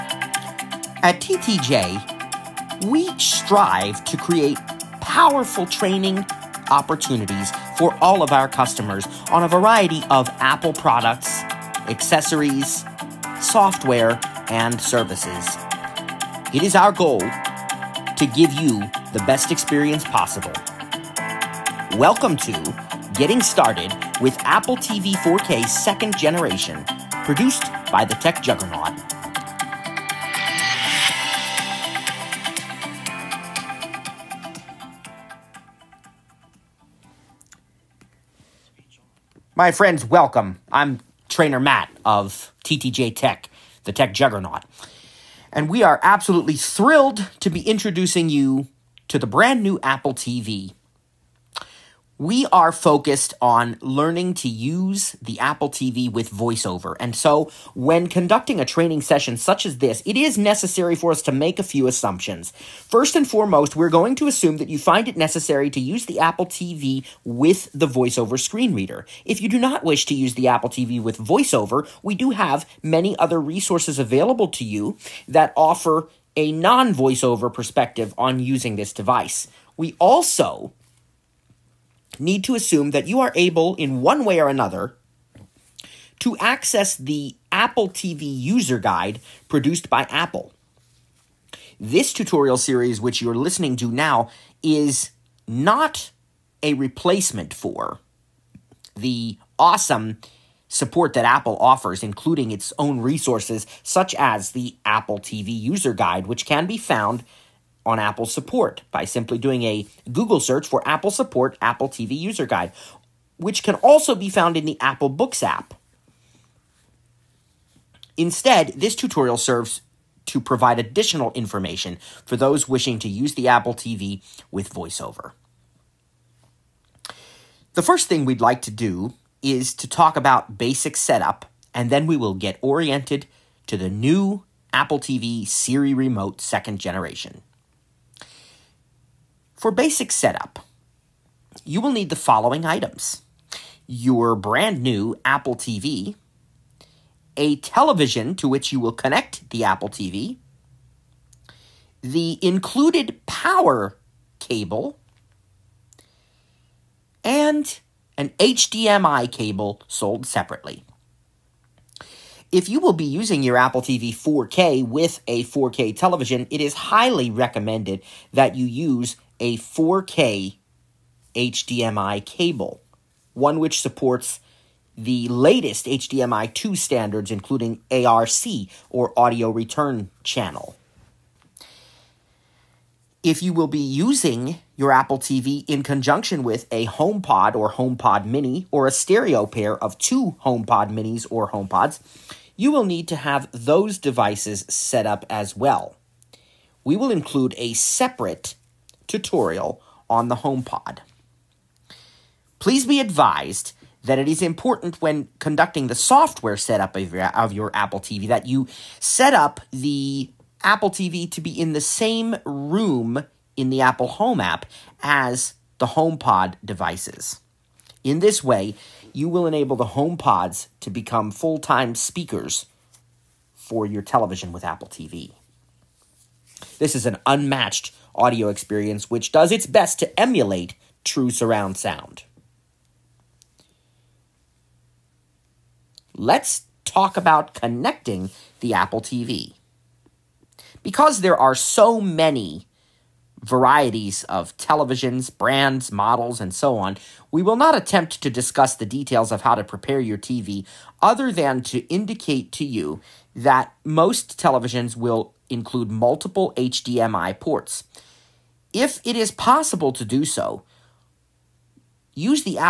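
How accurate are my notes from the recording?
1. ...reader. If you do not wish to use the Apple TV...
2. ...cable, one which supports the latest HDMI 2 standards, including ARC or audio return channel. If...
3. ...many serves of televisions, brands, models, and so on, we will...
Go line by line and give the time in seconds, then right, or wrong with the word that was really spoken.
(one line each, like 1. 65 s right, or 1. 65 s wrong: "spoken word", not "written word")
1. 68 s right
2. 172 s right
3. 241 s wrong: "varieties", not "serves".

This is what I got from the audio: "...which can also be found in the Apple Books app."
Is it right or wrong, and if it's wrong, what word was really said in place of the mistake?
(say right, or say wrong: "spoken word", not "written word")
right.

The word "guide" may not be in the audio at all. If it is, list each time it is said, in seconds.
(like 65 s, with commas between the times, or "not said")
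88 s, 105 s, 112 s.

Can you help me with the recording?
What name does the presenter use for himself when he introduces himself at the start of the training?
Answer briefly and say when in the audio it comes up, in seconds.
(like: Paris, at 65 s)
Trainer Matt, at 41 s.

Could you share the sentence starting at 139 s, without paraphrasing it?
For basic setup, you will need the following items.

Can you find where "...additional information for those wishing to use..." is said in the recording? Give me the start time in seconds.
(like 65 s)
120 s.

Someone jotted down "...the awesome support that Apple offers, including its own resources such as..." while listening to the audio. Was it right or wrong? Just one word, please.
right.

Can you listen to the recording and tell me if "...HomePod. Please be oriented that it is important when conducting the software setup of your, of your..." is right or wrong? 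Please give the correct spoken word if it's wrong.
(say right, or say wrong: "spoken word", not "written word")
wrong: "advised", not "oriented".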